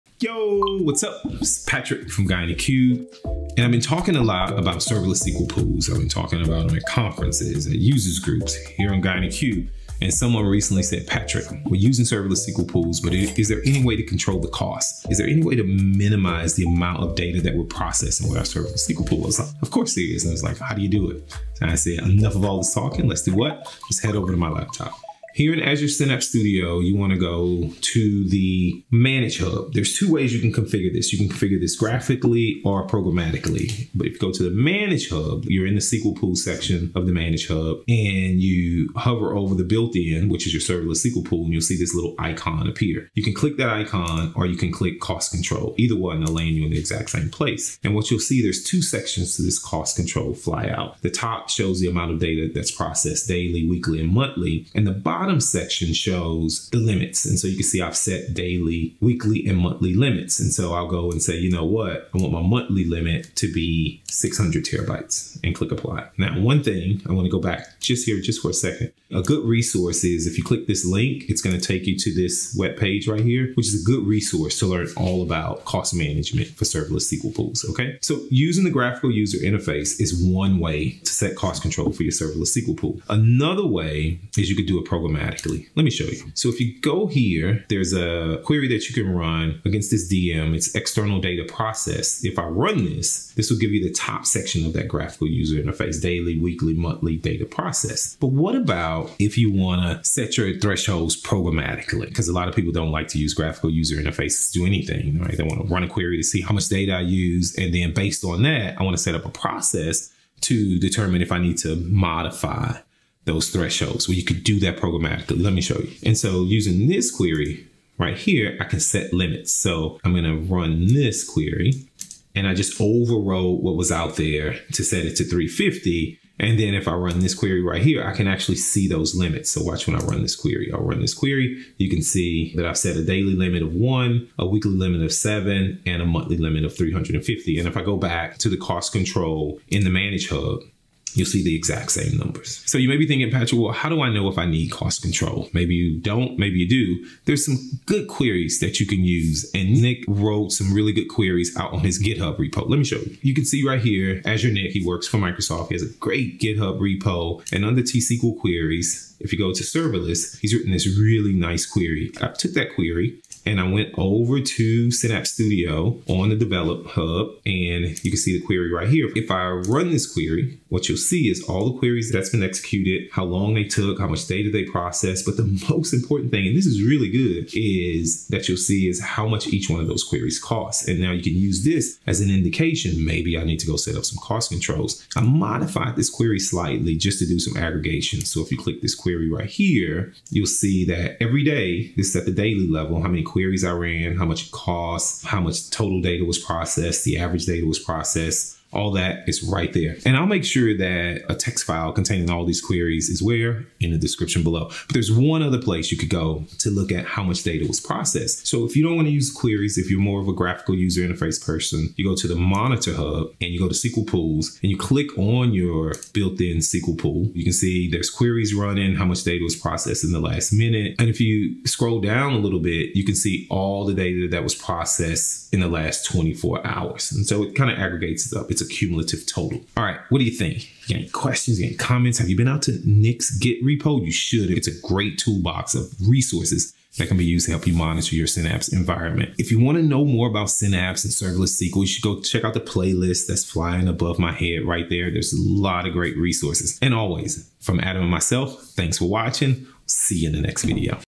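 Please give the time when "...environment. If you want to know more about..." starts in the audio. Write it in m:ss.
3:58.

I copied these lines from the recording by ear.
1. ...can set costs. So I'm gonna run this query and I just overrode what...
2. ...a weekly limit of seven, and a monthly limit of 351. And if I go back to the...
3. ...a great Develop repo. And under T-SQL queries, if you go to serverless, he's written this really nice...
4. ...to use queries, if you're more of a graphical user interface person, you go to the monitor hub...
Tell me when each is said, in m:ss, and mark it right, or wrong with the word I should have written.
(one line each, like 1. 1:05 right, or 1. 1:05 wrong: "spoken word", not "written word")
1. 1:58 wrong: "limits", not "costs"
2. 2:14 wrong: "350", not "351"
3. 2:35 wrong: "GitHub", not "Develop"
4. 3:29 right.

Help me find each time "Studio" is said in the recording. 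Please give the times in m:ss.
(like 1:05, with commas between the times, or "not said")
0:26, 2:45.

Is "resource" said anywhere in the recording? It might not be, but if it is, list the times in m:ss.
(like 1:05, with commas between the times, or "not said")
1:09, 1:14, 3:56, 4:06.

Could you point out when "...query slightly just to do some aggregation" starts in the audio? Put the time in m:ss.
3:06.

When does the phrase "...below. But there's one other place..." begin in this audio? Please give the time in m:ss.
3:24.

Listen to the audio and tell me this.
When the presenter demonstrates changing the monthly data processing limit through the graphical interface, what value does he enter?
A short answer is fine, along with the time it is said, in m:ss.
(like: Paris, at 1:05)
600 terabytes, at 1:04.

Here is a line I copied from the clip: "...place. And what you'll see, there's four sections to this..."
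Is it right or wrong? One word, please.
wrong.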